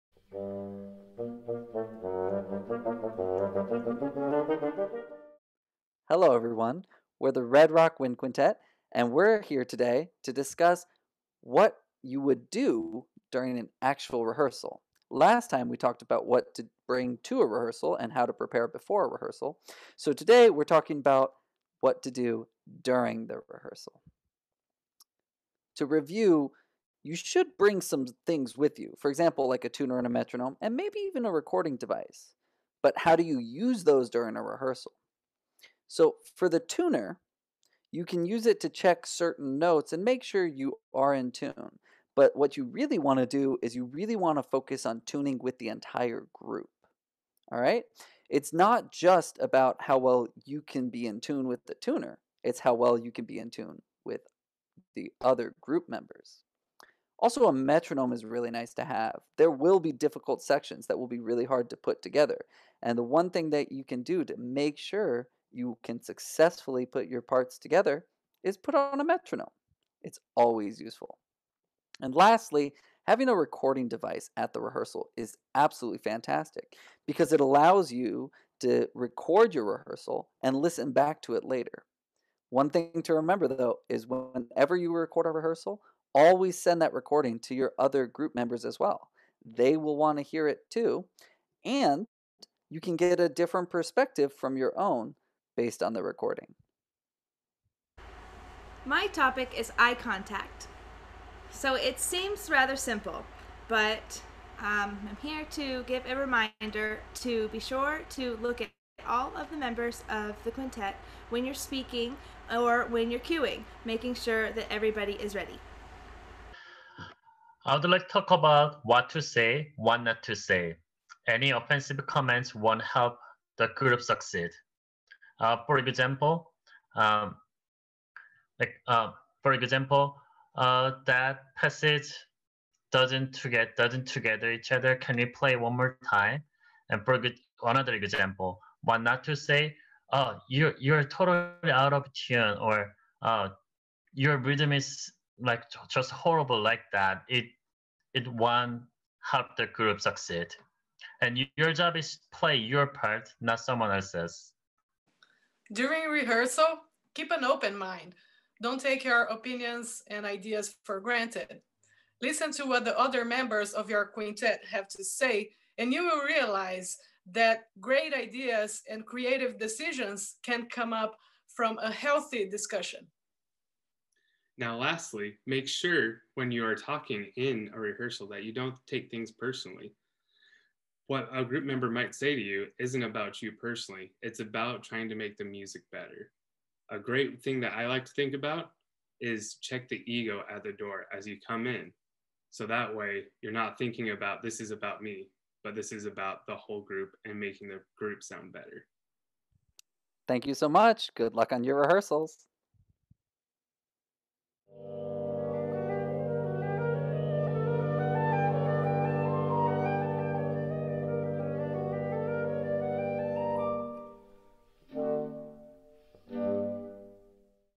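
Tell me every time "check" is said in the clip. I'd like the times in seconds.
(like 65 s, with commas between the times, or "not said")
38 s, 189 s.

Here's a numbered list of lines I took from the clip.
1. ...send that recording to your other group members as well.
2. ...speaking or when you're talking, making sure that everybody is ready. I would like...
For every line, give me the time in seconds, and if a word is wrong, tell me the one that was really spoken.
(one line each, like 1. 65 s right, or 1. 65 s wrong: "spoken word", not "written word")
1. 86 s right
2. 111 s wrong: "queuing", not "talking".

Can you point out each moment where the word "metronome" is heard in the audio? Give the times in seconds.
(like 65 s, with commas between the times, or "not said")
30 s, 57 s, 69 s.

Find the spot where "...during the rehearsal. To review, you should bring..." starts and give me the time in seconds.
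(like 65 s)
22 s.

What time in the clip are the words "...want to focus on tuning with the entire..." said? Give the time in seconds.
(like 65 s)
44 s.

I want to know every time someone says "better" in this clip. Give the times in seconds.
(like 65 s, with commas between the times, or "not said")
185 s, 198 s.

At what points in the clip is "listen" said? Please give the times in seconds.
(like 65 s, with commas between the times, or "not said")
80 s, 162 s.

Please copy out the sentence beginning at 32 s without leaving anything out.
But how do you use those during a rehearsal?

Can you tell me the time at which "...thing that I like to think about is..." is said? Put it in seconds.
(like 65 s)
187 s.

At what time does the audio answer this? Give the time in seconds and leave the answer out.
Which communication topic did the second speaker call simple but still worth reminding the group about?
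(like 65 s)
99 s.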